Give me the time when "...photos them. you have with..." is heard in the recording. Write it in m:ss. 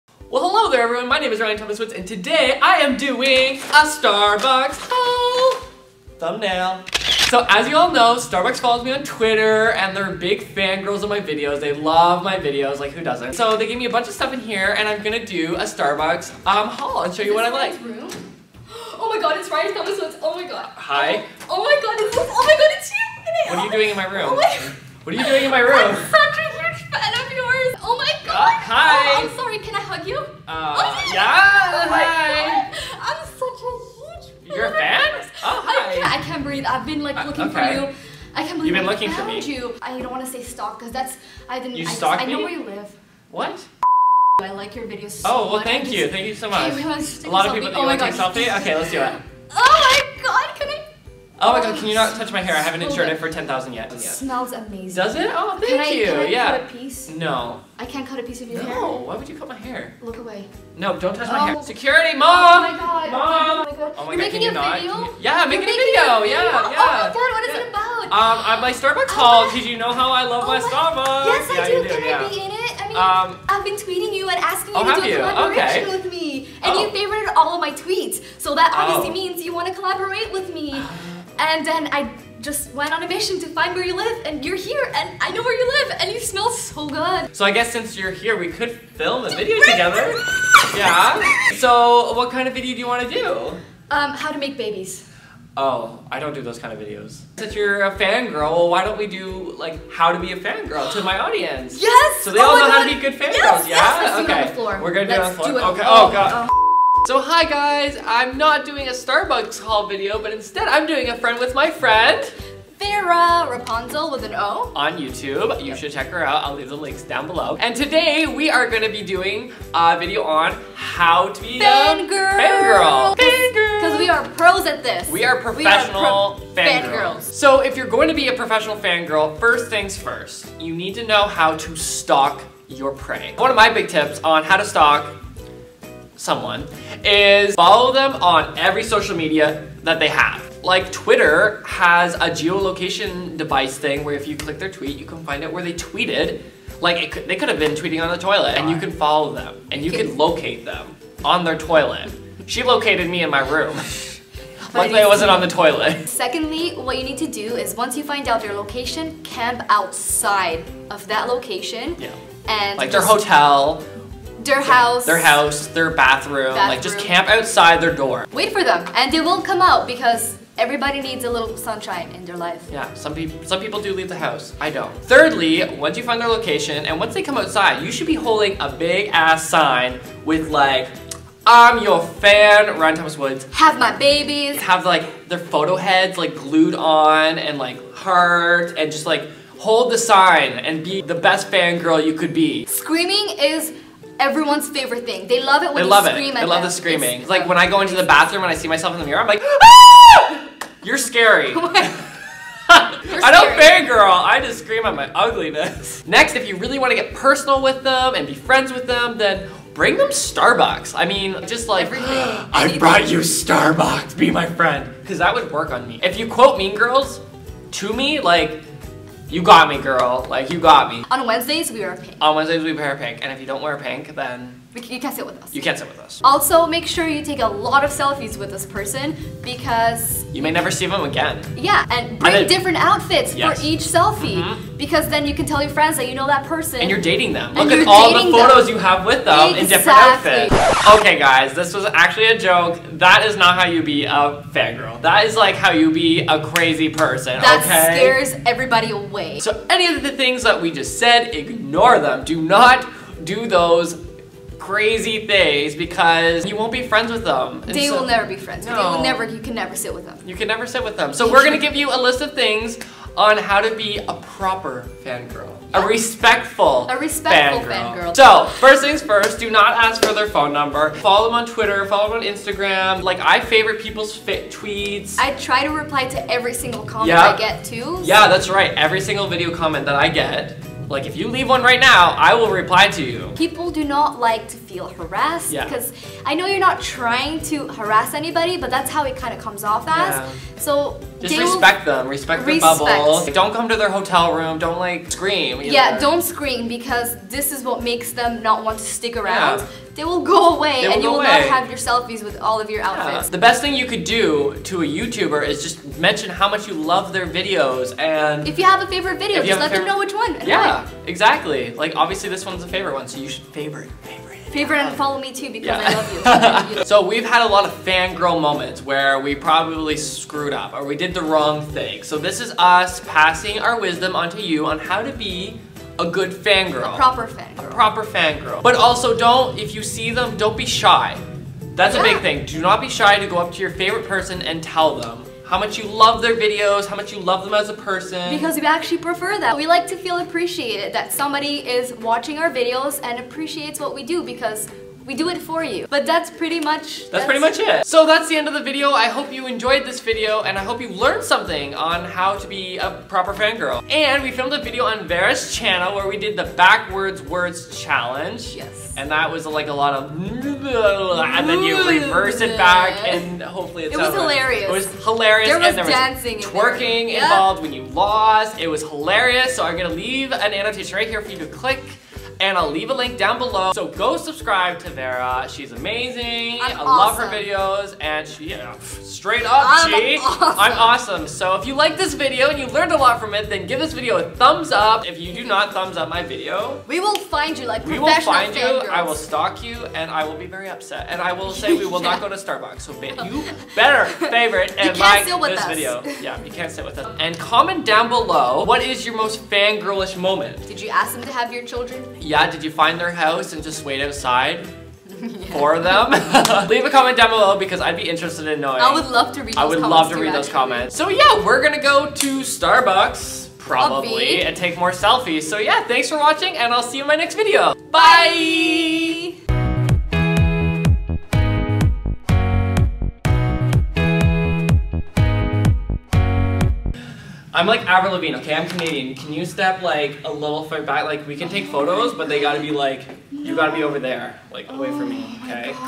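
3:58.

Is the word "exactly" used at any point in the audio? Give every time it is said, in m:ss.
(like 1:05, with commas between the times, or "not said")
3:59, 5:11.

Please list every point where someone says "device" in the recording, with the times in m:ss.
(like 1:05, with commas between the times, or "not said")
2:23.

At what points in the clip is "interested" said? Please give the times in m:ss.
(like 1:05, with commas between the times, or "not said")
6:48.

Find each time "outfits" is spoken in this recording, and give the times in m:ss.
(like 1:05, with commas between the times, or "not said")
3:52, 4:00, 5:02.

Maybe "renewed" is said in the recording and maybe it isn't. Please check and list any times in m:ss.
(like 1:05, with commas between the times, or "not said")
not said.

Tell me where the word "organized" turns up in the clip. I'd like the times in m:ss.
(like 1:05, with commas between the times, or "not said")
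not said.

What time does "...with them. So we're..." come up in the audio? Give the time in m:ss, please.
4:20.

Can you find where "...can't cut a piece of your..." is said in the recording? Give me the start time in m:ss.
0:57.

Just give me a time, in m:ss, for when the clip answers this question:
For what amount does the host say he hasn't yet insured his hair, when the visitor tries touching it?
0:53.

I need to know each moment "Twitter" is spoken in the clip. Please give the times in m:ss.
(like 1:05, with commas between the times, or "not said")
0:09, 2:20, 4:31.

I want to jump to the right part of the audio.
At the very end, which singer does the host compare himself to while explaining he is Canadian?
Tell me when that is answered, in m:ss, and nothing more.
7:07.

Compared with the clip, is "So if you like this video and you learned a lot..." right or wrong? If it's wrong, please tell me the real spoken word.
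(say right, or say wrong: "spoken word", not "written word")
right.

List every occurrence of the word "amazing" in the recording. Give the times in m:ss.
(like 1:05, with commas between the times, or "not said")
0:54, 6:15.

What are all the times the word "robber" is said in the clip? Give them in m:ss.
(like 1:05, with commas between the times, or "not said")
not said.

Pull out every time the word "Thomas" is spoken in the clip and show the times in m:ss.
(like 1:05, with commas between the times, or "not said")
0:01, 0:19, 3:02.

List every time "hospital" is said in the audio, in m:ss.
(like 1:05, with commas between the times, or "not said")
not said.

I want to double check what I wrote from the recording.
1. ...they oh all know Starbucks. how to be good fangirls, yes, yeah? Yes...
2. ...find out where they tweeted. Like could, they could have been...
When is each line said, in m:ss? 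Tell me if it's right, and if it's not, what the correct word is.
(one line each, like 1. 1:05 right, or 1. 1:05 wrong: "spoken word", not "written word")
1. 1:42 wrong: "God", not "Starbucks"
2. 2:25 right.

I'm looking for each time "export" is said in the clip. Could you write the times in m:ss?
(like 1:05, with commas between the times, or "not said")
not said.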